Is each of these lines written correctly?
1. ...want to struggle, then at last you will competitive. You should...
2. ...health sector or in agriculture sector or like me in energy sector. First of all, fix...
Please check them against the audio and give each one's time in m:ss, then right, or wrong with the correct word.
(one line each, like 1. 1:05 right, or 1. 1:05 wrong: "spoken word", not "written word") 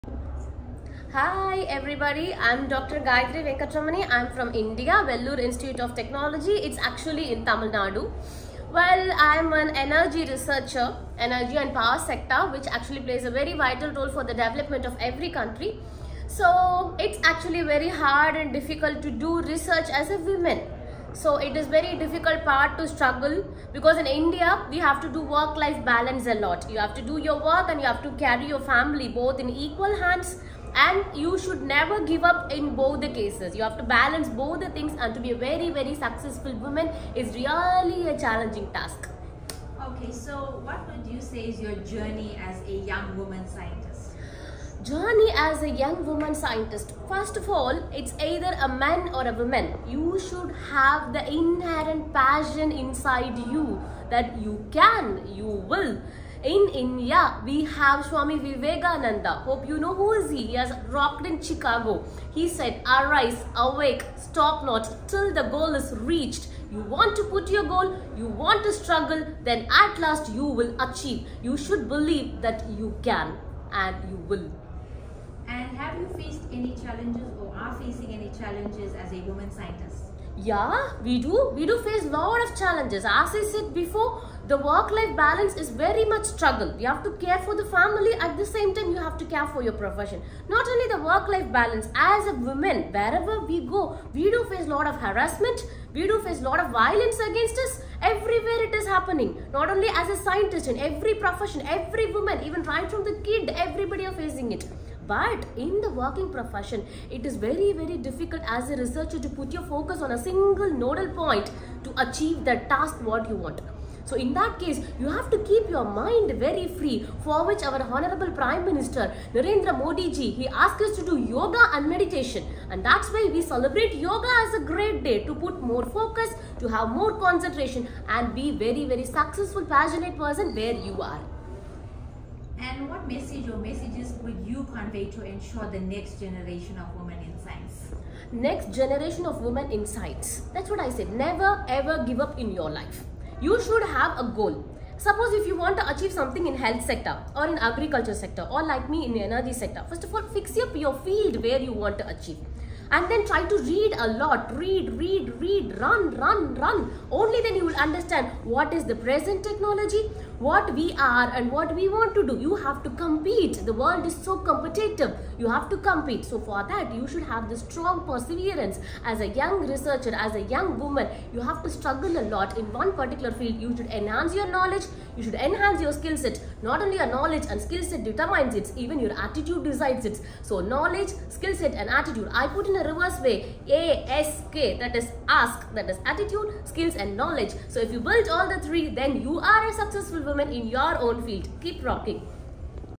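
1. 1:08 wrong: "achieve", not "competitive"
2. 2:26 right.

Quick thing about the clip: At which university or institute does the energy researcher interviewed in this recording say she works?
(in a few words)
Vellore Institute of Technology.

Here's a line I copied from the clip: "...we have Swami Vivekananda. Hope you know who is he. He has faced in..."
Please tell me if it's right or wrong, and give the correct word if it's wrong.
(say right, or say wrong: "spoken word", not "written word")
wrong: "rocked", not "faced".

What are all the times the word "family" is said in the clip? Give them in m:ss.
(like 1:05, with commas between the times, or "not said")
0:28, 1:27.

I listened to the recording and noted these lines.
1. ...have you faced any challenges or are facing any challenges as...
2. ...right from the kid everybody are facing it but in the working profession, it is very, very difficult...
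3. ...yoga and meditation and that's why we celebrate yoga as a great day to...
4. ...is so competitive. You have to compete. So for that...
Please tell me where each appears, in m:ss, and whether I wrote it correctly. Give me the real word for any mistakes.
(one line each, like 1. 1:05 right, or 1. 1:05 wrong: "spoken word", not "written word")
1. 1:15 right
2. 1:42 right
3. 2:01 right
4. 2:44 right.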